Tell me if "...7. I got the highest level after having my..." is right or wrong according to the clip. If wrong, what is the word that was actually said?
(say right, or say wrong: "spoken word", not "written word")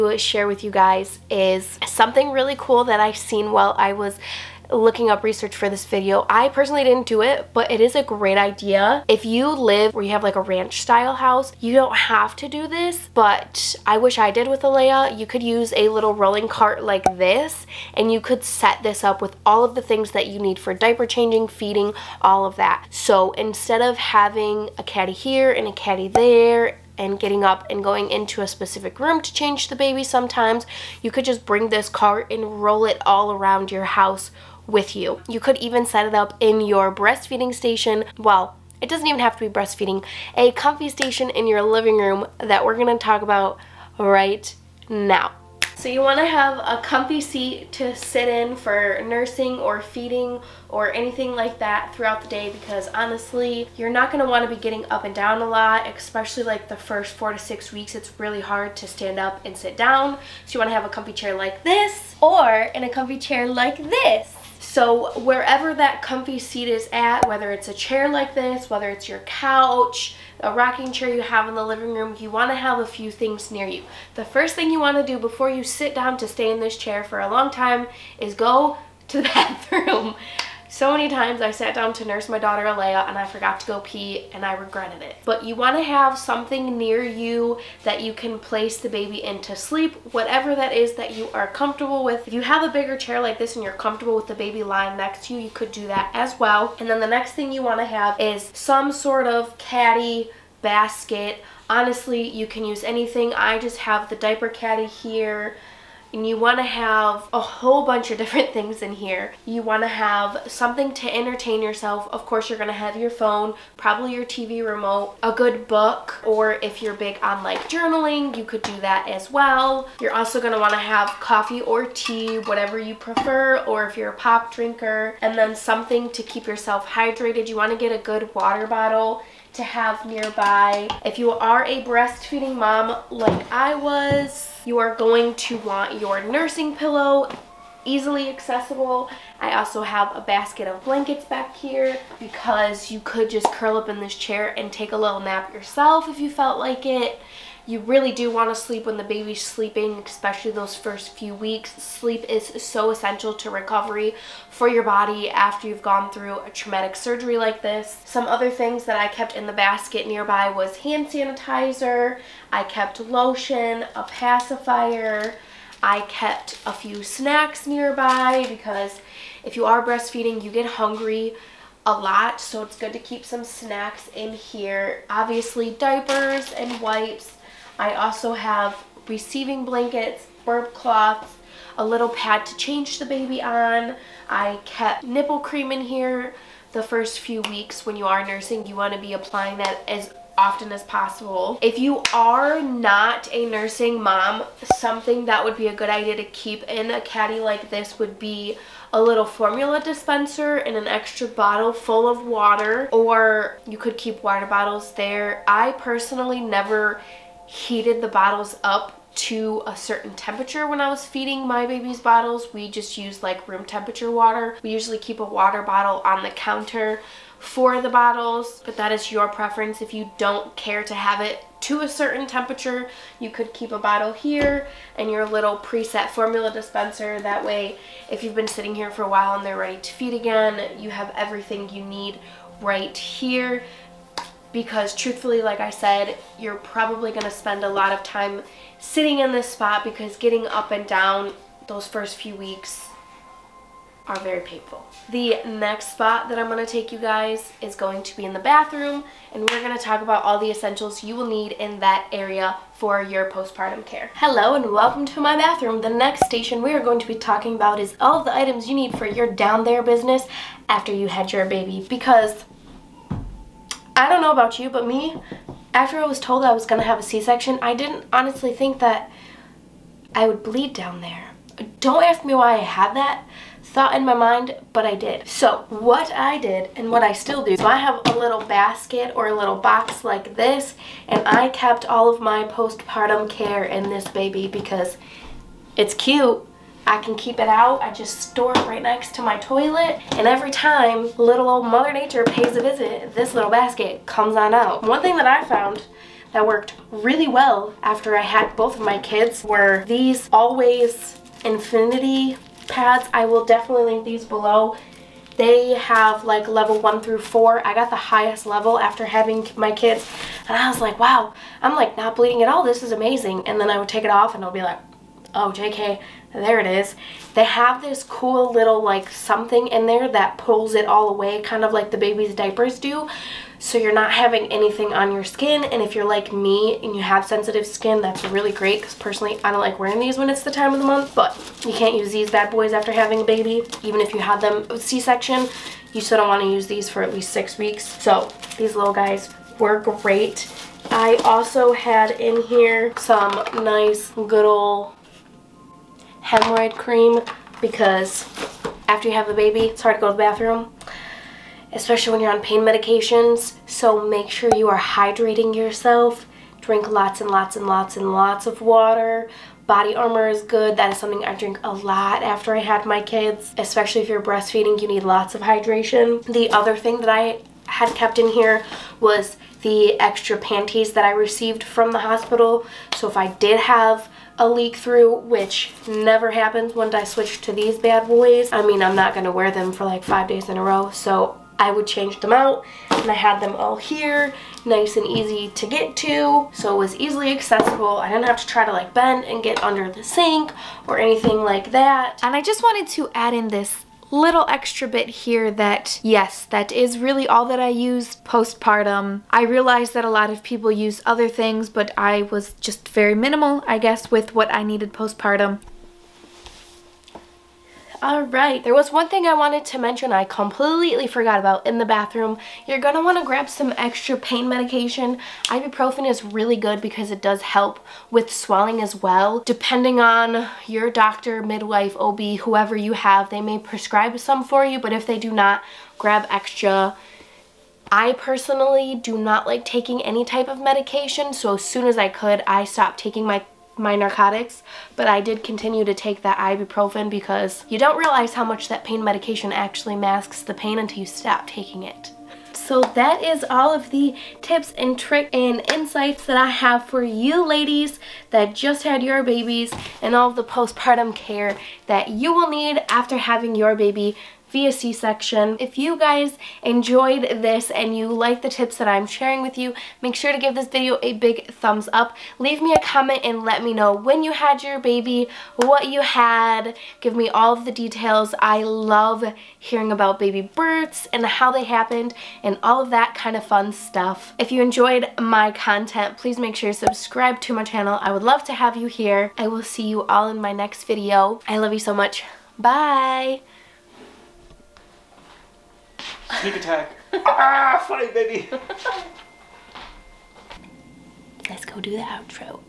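wrong: "4", not "7".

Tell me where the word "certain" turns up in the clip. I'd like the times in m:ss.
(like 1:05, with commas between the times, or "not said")
3:29, 3:41.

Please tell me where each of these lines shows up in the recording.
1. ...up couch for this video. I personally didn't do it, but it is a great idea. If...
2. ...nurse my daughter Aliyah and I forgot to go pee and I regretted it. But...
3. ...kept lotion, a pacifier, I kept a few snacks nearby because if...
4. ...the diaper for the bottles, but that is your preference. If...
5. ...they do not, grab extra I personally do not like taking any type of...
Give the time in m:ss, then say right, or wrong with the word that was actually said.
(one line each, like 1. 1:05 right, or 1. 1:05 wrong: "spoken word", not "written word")
1. 0:05 wrong: "research", not "couch"
2. 1:22 right
3. 2:42 right
4. 3:36 wrong: "counter", not "diaper"
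5. 7:05 right.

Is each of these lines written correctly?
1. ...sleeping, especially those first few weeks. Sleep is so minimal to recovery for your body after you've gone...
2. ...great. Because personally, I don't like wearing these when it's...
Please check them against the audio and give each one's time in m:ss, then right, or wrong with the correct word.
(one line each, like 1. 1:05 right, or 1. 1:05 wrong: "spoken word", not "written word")
1. 2:29 wrong: "essential", not "minimal"
2. 5:28 right.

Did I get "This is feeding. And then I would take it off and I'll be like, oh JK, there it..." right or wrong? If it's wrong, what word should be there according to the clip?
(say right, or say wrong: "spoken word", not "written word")
wrong: "amazing", not "feeding".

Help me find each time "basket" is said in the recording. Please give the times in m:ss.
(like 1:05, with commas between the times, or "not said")
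1:40, 2:20, 2:39, 4:38, 4:53.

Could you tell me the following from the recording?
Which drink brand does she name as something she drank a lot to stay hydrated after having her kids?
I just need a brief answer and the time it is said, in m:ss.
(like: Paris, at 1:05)
Body Armor, at 5:59.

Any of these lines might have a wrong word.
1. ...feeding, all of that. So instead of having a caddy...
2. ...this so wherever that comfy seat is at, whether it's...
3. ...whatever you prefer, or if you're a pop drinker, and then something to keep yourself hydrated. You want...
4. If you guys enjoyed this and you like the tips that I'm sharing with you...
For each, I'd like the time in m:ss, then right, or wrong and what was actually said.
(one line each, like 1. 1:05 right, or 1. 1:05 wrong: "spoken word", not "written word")
1. 0:21 right
2. 1:03 right
3. 2:02 right
4. 7:35 right.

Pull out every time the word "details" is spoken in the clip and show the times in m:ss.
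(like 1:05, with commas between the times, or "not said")
7:47.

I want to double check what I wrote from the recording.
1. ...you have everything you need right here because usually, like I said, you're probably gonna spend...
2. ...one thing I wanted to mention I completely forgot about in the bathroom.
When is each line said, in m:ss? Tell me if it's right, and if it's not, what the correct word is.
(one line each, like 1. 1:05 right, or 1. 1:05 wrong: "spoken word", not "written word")
1. 3:50 wrong: "truthfully", not "usually"
2. 6:48 right.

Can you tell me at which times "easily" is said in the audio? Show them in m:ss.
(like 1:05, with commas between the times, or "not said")
2:17, 6:26.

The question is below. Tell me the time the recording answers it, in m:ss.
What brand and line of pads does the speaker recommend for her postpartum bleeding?
5:00.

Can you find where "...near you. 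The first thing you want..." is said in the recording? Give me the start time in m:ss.
1:13.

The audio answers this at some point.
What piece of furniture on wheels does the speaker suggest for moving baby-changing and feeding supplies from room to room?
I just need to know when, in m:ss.
0:16.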